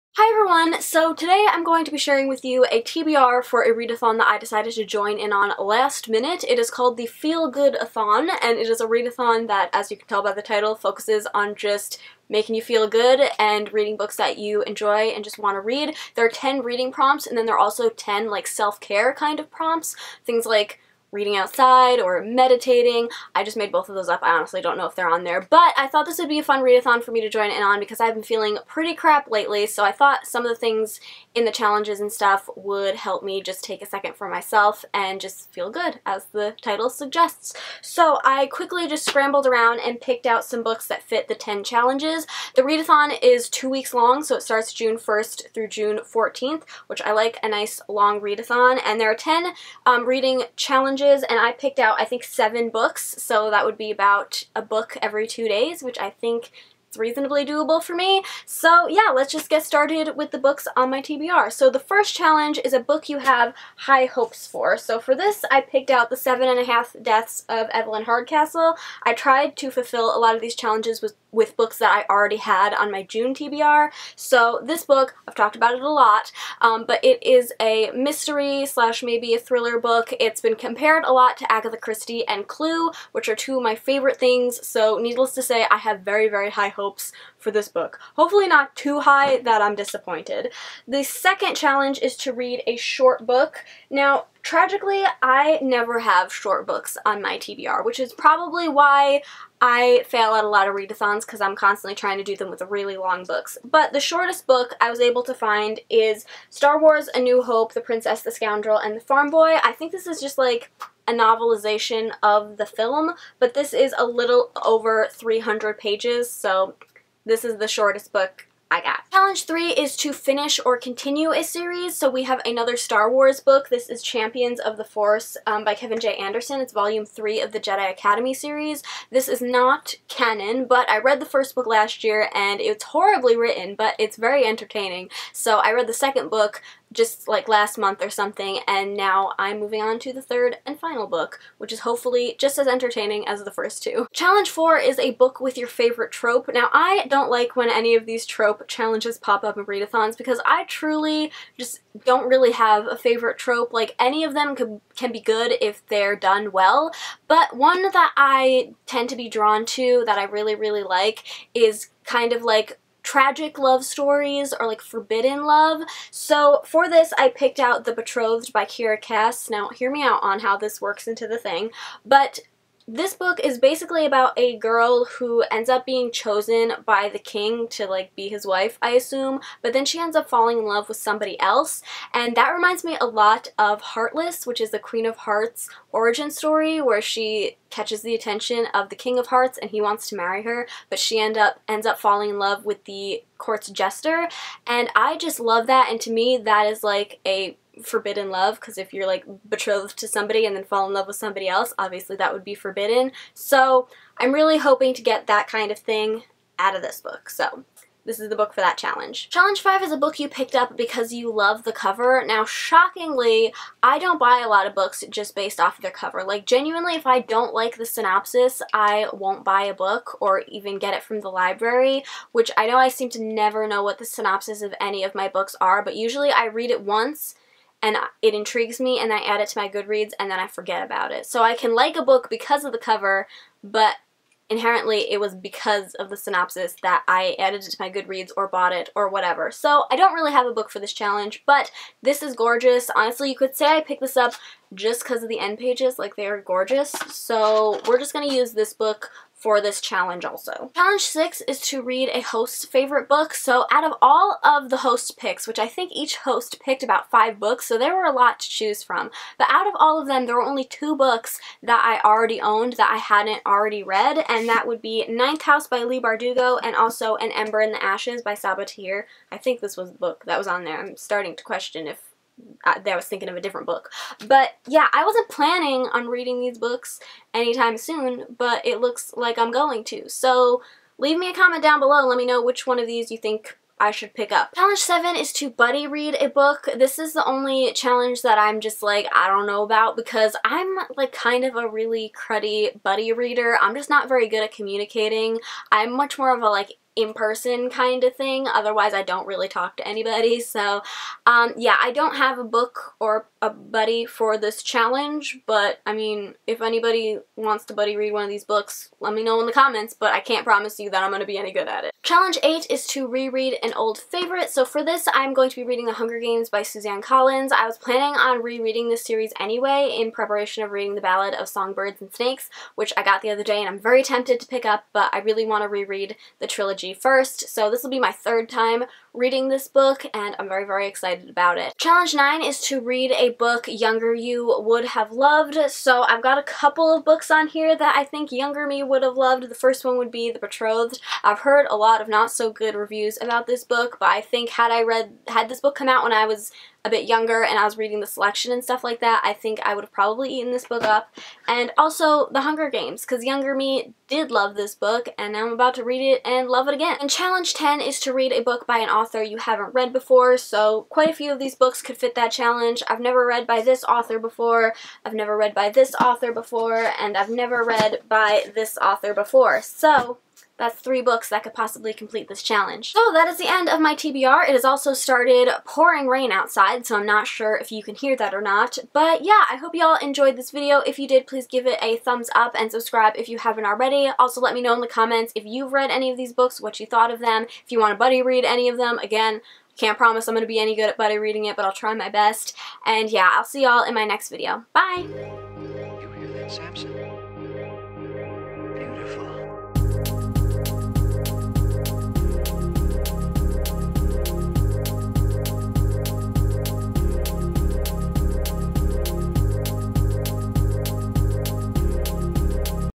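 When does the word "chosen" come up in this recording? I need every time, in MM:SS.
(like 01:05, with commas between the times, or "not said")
02:56.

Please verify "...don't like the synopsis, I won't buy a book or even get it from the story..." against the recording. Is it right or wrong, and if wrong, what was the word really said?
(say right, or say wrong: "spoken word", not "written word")
wrong: "library", not "story".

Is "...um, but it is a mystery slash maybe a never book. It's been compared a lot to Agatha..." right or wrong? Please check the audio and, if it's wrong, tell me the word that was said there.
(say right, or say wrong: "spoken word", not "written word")
wrong: "thriller", not "never".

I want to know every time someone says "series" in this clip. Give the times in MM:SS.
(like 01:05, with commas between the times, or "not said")
02:01, 02:08, 05:19.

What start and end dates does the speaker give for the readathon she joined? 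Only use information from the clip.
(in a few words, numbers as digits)
June 1st through June 14th.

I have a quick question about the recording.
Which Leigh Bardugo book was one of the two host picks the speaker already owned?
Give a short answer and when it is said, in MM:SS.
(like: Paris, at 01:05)
Ninth House, at 04:25.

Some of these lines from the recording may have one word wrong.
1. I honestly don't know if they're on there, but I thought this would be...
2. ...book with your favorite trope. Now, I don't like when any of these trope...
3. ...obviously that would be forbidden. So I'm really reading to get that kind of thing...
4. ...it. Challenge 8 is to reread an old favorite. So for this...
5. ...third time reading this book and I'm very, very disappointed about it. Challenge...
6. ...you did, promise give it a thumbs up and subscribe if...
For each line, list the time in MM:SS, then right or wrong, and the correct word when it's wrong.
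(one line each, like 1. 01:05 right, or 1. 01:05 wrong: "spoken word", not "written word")
1. 00:24 right
2. 02:25 right
3. 03:21 wrong: "hoping", not "reading"
4. 05:11 right
5. 05:28 wrong: "excited", not "disappointed"
6. 06:20 wrong: "please", not "promise".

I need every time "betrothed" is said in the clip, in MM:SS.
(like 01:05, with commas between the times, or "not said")
02:47, 03:19, 05:40.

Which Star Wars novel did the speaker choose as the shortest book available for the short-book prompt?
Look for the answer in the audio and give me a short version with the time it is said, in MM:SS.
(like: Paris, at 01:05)
A New Hope, at 01:47.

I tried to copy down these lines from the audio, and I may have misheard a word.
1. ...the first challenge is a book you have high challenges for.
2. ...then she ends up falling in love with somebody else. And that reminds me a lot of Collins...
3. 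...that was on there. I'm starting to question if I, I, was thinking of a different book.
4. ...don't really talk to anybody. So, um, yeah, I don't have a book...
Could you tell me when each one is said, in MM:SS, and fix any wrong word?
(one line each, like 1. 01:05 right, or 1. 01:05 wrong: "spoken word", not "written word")
1. 01:01 wrong: "hopes", not "challenges"
2. 02:59 wrong: "Heartless", not "Collins"
3. 04:30 right
4. 04:59 right.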